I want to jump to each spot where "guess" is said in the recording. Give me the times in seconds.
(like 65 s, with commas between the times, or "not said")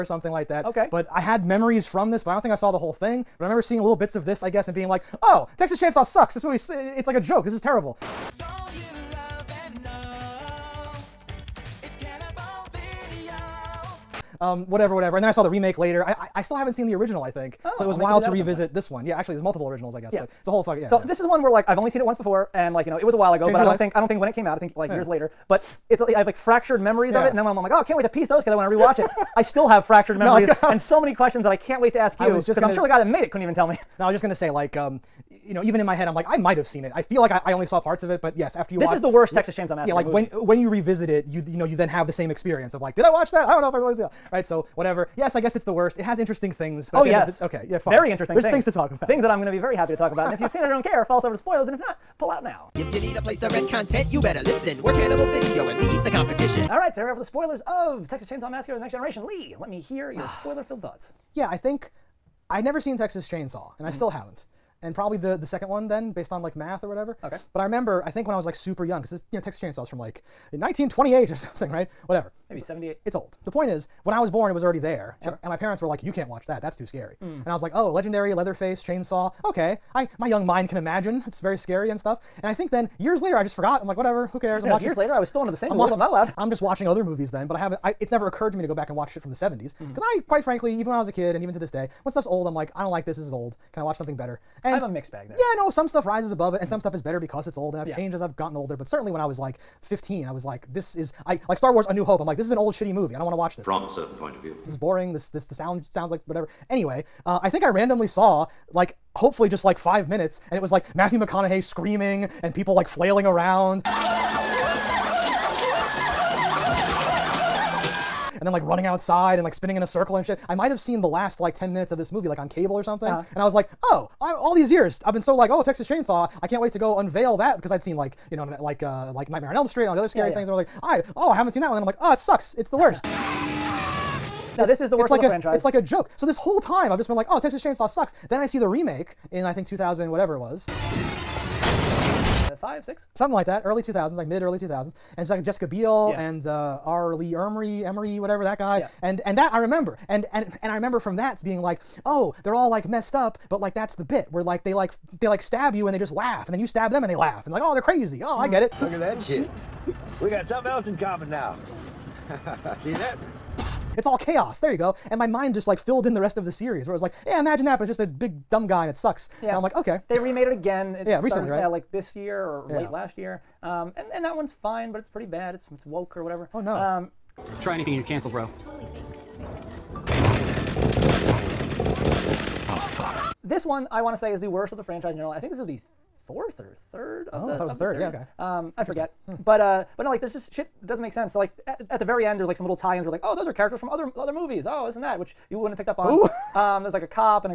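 4 s, 20 s, 45 s.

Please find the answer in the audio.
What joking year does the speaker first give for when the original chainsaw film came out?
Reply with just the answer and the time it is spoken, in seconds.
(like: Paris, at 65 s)
1928, at 70 s.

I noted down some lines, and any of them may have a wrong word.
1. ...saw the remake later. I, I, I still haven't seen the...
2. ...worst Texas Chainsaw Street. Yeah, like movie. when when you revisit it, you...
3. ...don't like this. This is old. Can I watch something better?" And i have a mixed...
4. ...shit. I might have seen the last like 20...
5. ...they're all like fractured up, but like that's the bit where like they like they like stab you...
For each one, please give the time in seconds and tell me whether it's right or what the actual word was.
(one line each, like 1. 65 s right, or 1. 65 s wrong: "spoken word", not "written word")
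1. 15 s right
2. 39 s wrong: "Massacre", not "Street"
3. 92 s right
4. 120 s wrong: "10", not "20"
5. 152 s wrong: "messed", not "fractured".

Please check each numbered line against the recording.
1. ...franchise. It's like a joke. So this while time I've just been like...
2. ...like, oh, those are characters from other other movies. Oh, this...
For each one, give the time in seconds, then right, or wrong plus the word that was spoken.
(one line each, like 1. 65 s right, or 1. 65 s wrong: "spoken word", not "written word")
1. 135 s wrong: "whole", not "while"
2. 193 s right.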